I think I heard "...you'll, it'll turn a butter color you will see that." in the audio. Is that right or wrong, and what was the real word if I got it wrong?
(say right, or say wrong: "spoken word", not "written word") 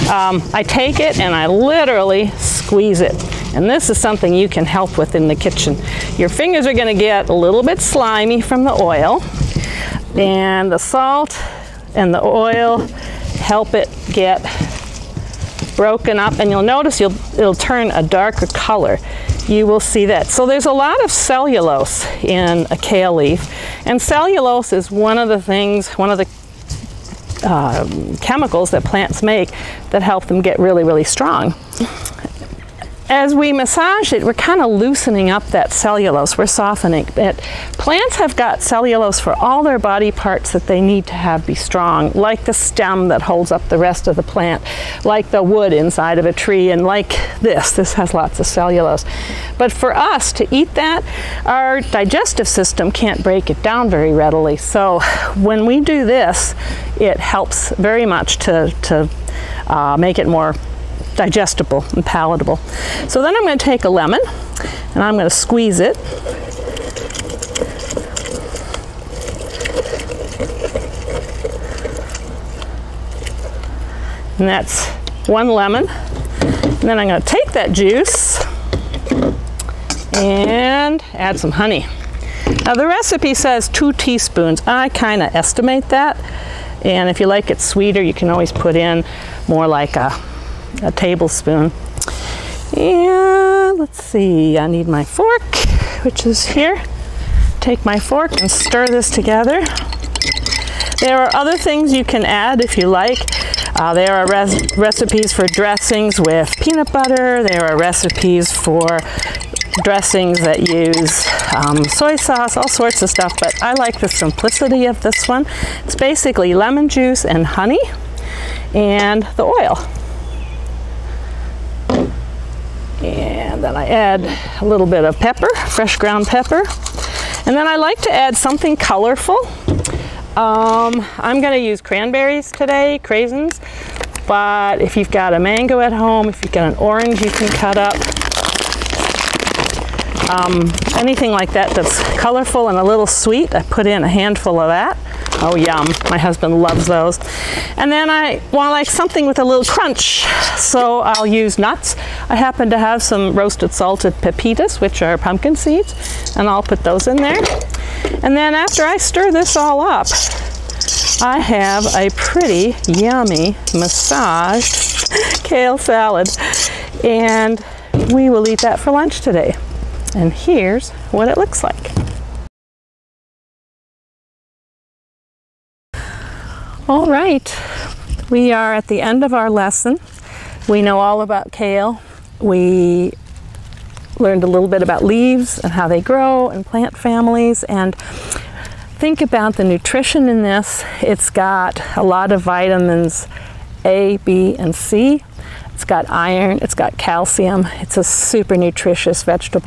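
wrong: "darker", not "butter".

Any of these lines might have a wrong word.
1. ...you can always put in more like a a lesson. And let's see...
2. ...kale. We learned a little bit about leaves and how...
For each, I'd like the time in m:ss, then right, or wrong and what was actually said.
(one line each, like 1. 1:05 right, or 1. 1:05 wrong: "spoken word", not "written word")
1. 1:28 wrong: "tablespoon", not "lesson"
2. 3:01 right.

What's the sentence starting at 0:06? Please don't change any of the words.
Your fingers are going to get a little bit slimy from the oil.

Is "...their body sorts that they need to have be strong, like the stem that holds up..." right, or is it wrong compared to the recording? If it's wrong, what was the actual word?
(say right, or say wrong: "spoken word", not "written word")
wrong: "parts", not "sorts".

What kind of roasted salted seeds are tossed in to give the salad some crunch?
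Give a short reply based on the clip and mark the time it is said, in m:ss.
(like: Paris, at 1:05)
Pepitas, at 2:34.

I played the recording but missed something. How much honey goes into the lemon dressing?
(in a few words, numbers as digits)
2 teaspoons.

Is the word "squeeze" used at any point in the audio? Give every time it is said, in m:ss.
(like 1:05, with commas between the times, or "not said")
0:02, 1:05.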